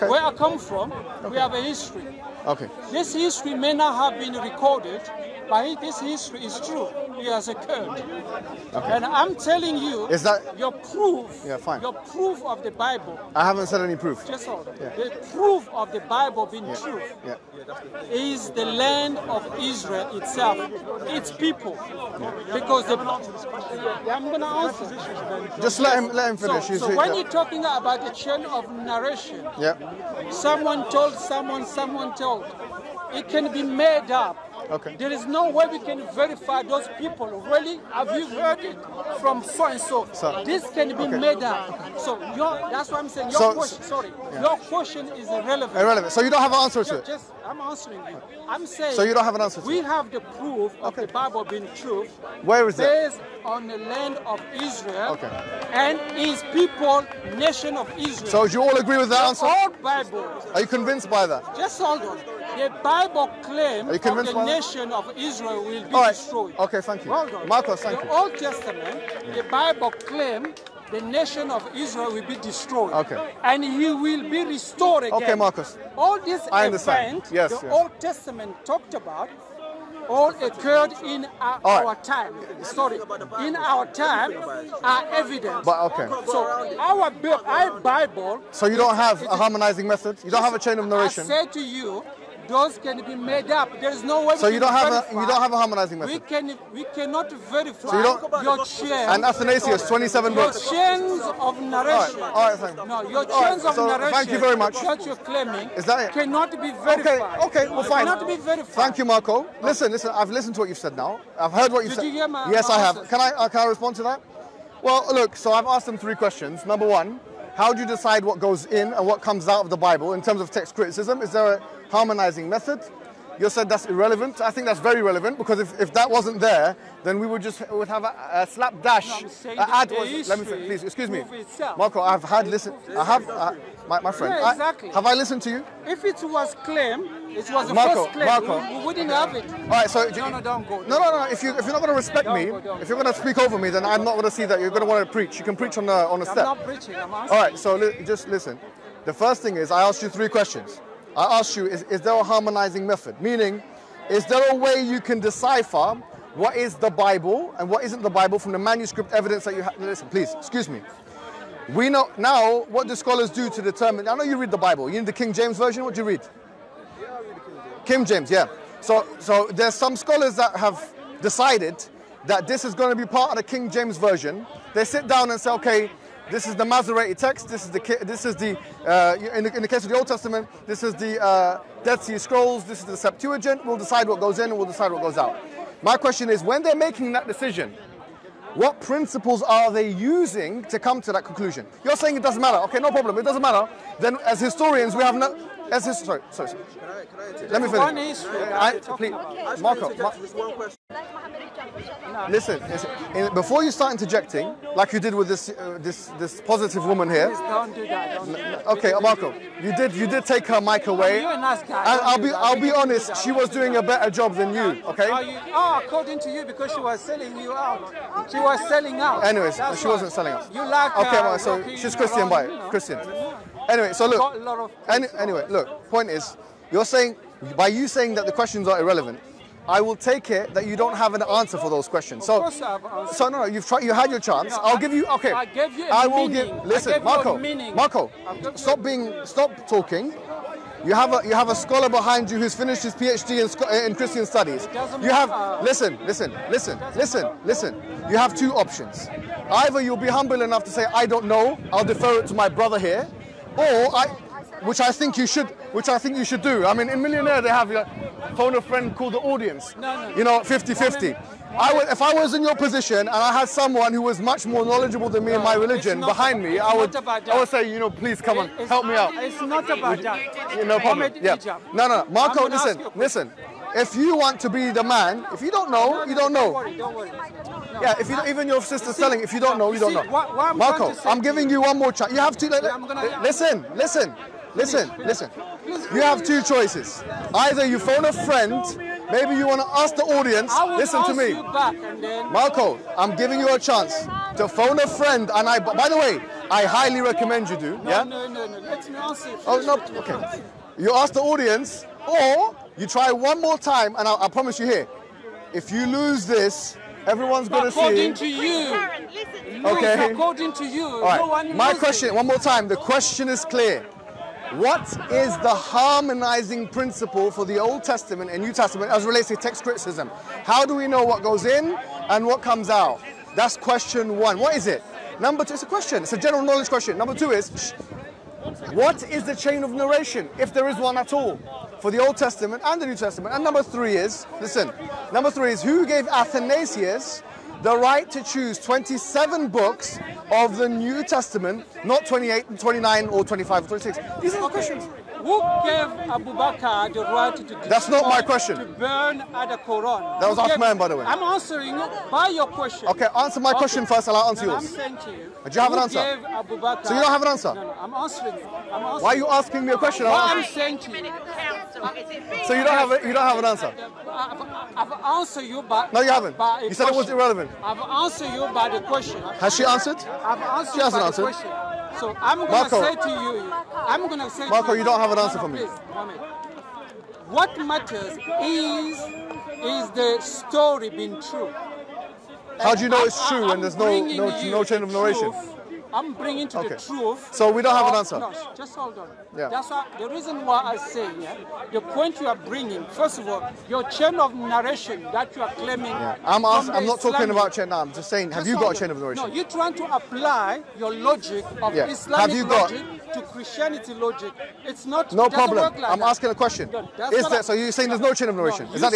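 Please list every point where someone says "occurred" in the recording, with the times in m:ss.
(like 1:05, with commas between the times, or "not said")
0:07, 1:20.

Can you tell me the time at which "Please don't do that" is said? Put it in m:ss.
3:27.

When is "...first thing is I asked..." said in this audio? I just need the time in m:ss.
2:29.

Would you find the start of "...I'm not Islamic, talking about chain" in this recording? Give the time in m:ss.
6:36.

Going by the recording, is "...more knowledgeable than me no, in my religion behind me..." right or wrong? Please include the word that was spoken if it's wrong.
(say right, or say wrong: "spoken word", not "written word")
right.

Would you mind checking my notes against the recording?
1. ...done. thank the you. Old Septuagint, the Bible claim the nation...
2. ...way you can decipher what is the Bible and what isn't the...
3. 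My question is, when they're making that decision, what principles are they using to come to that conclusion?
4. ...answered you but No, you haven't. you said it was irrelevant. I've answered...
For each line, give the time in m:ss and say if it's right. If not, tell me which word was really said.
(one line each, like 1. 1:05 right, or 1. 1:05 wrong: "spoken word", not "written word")
1. 1:07 wrong: "Testament", not "Septuagint"
2. 2:34 right
3. 3:05 right
4. 6:05 right.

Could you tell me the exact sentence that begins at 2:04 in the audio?
I think that's very relevant because if, if that wasn't there, then we would just would have a, a slapdash no, ad.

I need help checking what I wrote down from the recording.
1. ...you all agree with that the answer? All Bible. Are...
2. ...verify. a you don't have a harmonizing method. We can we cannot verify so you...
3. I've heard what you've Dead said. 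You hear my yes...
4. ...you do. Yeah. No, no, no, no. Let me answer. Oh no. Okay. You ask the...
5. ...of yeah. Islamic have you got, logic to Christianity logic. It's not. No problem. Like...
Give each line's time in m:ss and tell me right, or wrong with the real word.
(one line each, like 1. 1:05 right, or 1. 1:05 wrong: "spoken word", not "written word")
1. 0:58 right
2. 1:34 right
3. 1:51 wrong: "Did", not "Dead"
4. 4:57 right
5. 6:41 right.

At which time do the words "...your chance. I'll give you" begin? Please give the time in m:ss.
3:54.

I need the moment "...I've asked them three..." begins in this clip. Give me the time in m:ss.
1:55.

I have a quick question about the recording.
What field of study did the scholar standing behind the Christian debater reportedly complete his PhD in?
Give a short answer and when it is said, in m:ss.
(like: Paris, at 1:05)
Christian studies, at 4:03.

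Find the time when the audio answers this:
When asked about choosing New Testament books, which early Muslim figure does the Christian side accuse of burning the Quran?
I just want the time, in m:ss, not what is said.
5:46.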